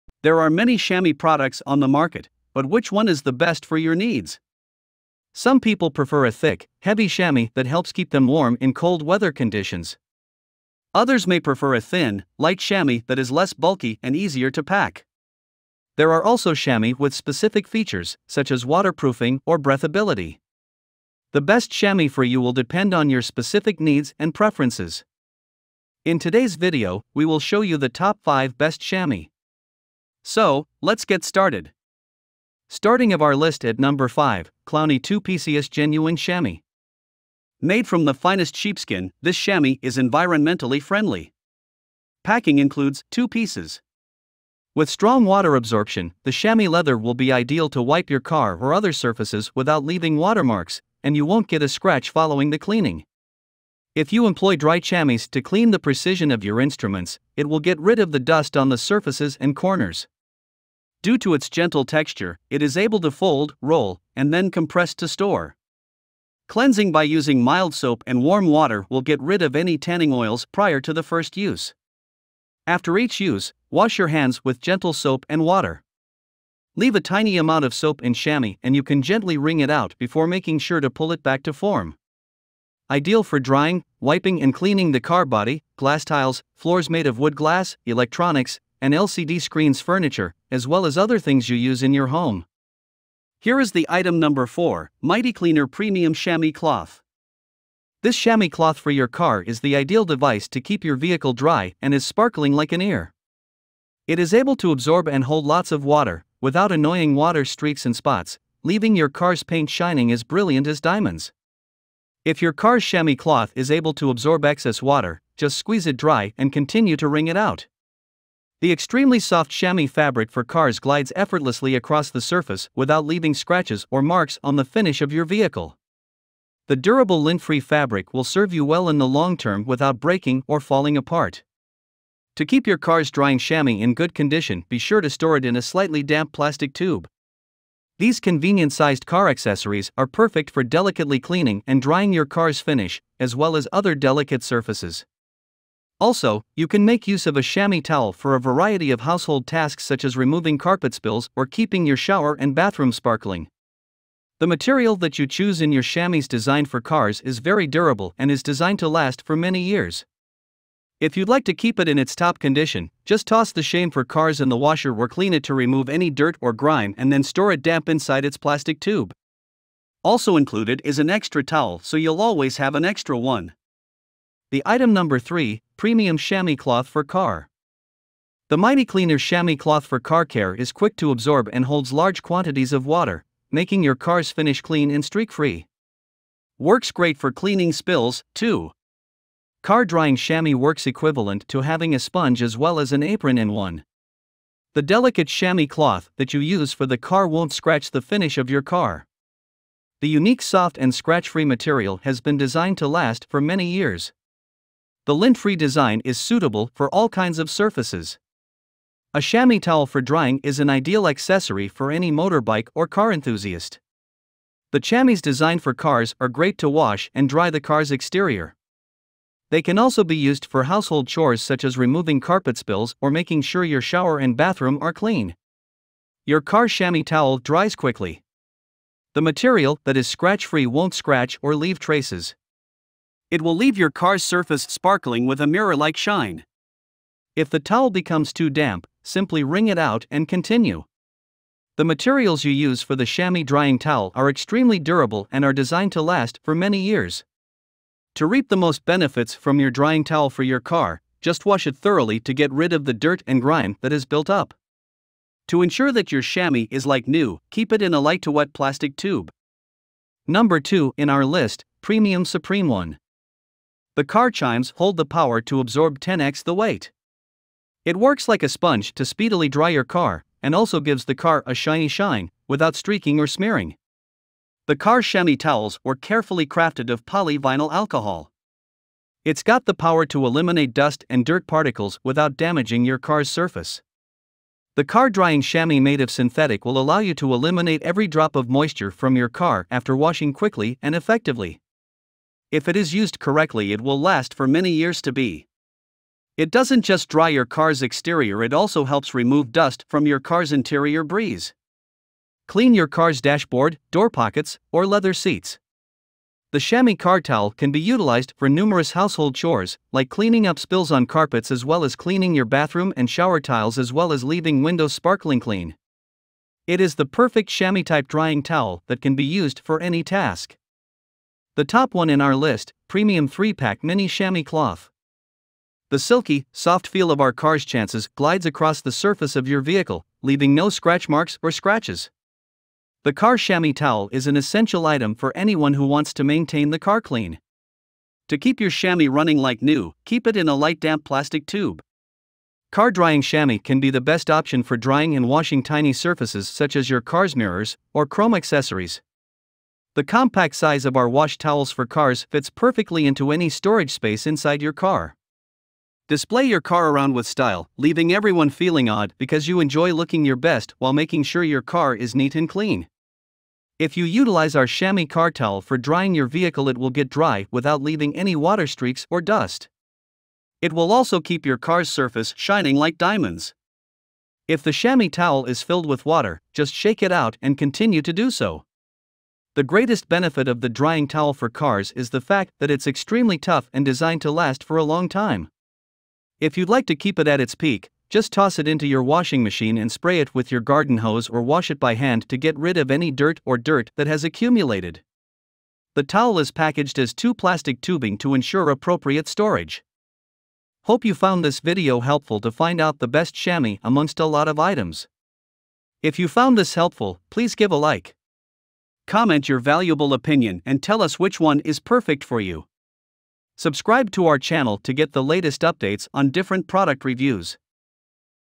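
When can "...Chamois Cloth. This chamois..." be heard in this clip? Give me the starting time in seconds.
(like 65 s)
96 s.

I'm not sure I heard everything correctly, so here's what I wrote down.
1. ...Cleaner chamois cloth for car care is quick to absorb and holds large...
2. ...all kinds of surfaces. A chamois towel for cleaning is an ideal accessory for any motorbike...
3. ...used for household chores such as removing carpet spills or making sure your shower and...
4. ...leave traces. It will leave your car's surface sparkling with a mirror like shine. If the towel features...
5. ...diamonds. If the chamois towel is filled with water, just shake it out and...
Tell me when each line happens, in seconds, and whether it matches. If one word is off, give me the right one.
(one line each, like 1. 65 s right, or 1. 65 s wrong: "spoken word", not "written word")
1. 178 s right
2. 206 s wrong: "drying", not "cleaning"
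3. 220 s right
4. 231 s wrong: "becomes", not "features"
5. 372 s right.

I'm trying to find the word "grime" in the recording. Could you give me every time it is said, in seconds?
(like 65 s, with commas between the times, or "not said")
166 s, 253 s.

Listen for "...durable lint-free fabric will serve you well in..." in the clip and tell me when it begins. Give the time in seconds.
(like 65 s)
126 s.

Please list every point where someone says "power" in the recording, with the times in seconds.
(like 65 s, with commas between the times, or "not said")
265 s, 279 s.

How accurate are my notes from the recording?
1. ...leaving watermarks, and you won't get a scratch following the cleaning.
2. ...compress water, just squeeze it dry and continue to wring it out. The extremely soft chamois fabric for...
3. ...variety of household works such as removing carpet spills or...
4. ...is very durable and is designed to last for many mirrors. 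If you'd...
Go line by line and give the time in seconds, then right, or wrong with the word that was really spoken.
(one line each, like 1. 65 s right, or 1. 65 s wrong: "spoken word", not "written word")
1. 49 s right
2. 114 s wrong: "excess", not "compress"
3. 148 s wrong: "tasks", not "works"
4. 157 s wrong: "years", not "mirrors".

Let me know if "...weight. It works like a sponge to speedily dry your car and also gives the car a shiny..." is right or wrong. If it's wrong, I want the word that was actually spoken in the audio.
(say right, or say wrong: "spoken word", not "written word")
right.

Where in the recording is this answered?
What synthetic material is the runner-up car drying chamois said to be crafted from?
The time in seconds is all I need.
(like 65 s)
277 s.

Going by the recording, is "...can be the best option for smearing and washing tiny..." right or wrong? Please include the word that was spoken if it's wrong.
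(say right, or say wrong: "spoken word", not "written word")
wrong: "drying", not "smearing".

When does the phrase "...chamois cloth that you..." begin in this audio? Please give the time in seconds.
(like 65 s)
195 s.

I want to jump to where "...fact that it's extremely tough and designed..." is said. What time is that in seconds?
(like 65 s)
382 s.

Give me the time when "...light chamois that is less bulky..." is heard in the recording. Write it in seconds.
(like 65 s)
12 s.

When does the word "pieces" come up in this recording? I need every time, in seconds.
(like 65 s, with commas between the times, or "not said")
35 s, 43 s.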